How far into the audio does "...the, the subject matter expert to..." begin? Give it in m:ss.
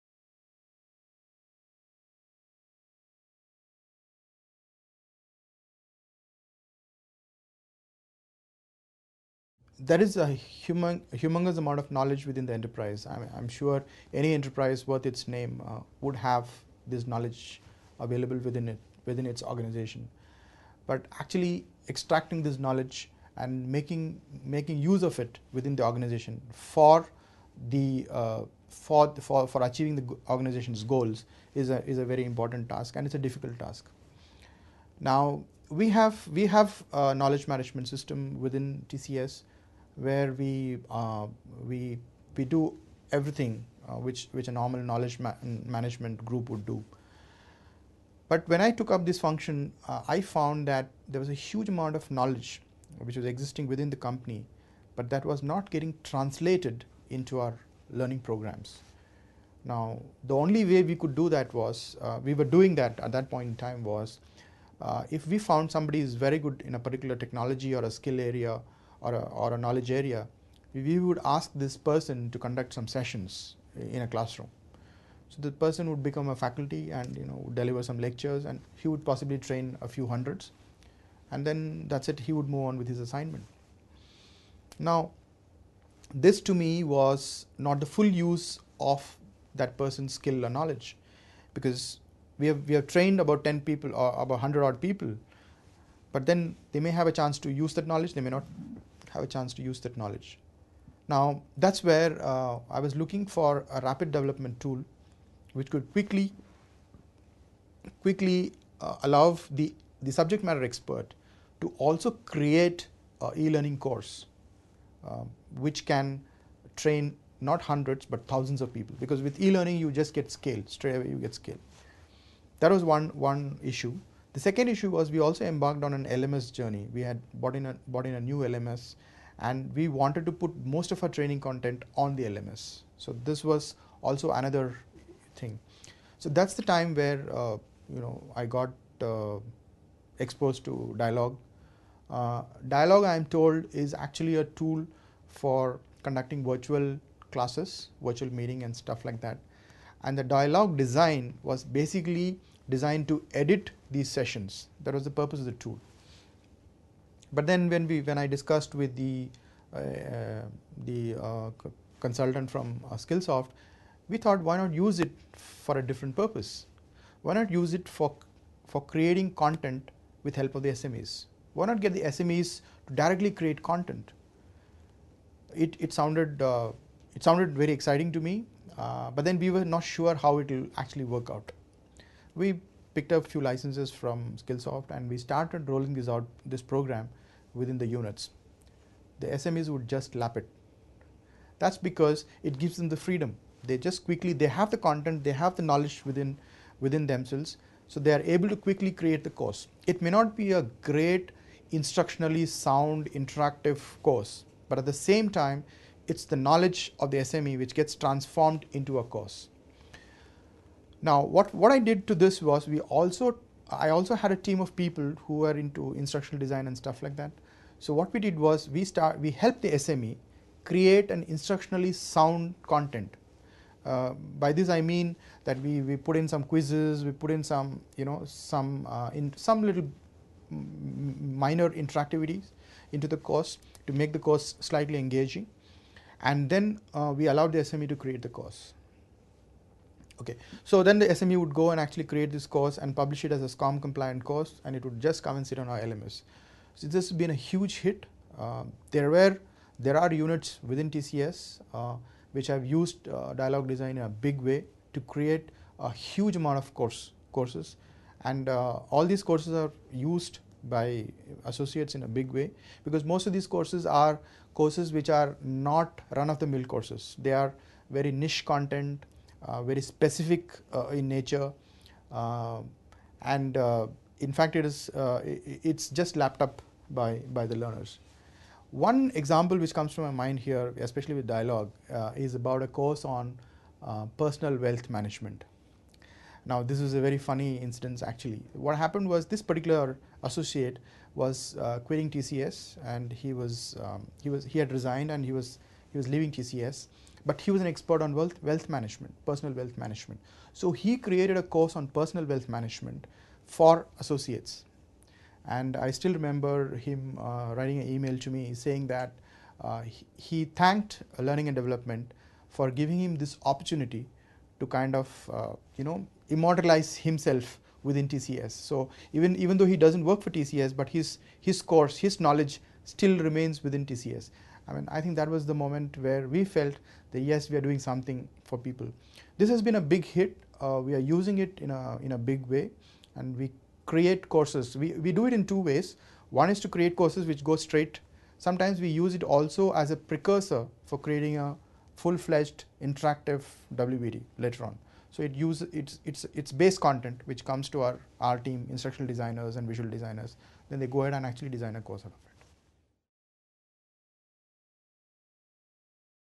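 1:49.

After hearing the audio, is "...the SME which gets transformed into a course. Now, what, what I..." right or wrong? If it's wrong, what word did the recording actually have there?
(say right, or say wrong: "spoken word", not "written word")
right.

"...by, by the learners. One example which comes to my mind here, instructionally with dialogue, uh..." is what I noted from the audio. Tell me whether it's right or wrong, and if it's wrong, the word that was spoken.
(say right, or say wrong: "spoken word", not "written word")
wrong: "especially", not "instructionally".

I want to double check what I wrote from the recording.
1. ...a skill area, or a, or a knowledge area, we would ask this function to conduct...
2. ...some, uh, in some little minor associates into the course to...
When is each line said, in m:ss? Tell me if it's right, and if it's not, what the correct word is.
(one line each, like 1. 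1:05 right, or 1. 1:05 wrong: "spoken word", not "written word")
1. 1:07 wrong: "person", not "function"
2. 3:48 wrong: "interactivities", not "associates".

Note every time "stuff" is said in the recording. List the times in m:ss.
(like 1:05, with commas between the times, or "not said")
2:28, 3:36.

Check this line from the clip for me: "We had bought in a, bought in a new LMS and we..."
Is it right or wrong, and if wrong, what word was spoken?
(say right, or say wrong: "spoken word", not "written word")
right.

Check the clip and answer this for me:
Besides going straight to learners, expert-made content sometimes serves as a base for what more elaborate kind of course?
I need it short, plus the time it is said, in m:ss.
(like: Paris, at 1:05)
Interactive WBT, at 5:42.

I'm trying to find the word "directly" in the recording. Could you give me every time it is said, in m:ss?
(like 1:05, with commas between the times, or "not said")
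2:52.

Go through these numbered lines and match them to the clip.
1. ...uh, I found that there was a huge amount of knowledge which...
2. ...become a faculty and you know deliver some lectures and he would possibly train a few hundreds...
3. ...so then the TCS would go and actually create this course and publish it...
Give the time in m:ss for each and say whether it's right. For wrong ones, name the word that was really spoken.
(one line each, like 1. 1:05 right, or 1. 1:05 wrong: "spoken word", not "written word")
1. 0:49 right
2. 1:16 right
3. 4:00 wrong: "SME", not "TCS".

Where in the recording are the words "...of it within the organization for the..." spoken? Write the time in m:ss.
0:25.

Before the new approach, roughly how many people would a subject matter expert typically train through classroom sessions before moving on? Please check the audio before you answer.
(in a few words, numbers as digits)
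100.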